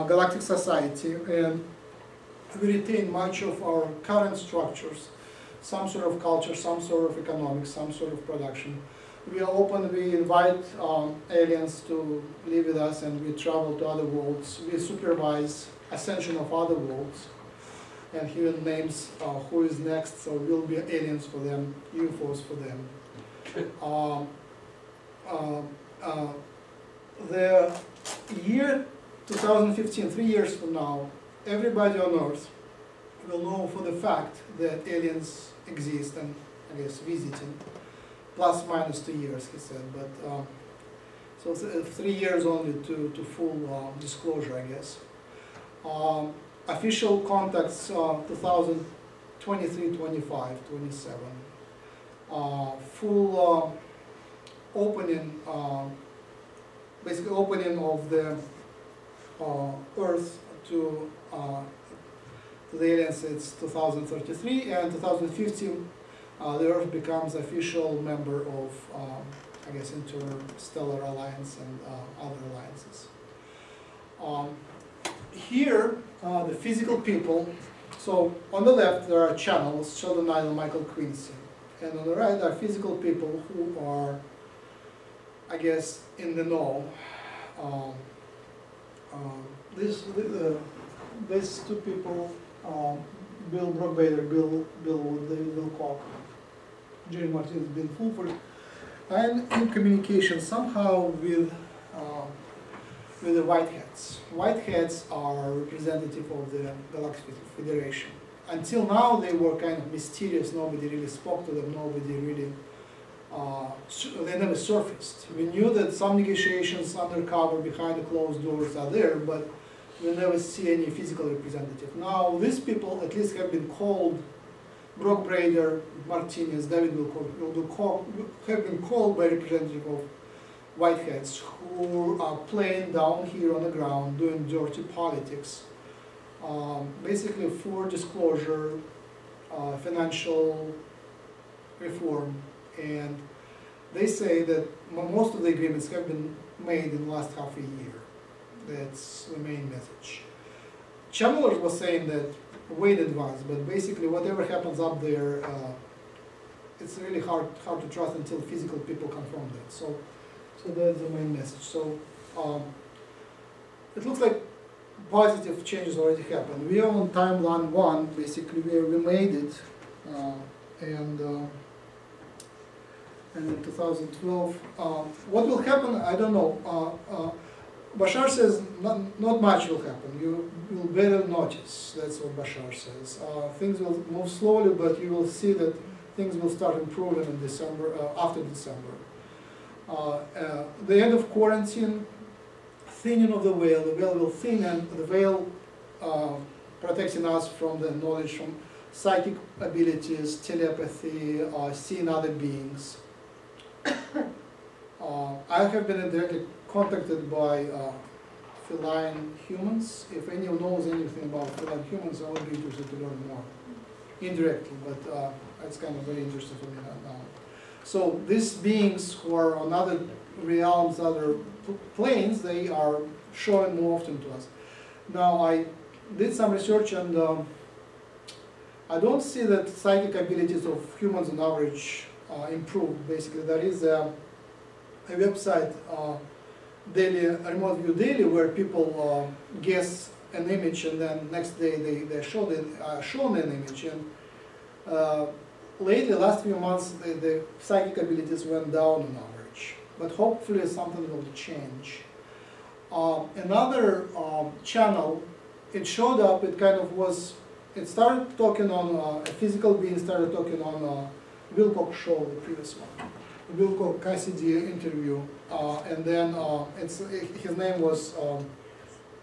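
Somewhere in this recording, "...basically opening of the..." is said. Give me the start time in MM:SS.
00:57.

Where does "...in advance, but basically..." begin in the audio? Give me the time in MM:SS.
02:32.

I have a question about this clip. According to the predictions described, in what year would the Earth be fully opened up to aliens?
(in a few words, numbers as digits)
2033.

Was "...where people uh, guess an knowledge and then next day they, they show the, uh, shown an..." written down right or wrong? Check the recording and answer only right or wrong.
wrong.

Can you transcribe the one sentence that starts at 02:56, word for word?
I don't know uh, uh, Bashar says not, not, much will happen.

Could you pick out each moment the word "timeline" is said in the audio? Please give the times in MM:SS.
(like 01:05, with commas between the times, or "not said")
02:47.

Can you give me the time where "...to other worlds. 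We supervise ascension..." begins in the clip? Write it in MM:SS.
00:13.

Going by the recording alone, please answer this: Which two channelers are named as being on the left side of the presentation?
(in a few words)
Sheldan Nidle and Michael Quinsey.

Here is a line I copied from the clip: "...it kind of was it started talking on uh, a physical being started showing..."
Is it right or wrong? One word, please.
wrong.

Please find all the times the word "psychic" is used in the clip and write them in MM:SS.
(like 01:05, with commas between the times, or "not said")
03:18, 03:49, 04:07.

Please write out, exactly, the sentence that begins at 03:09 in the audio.
Uh, uh the end of quarantine, thinning of the veil.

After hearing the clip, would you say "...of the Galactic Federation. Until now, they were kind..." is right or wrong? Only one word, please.
right.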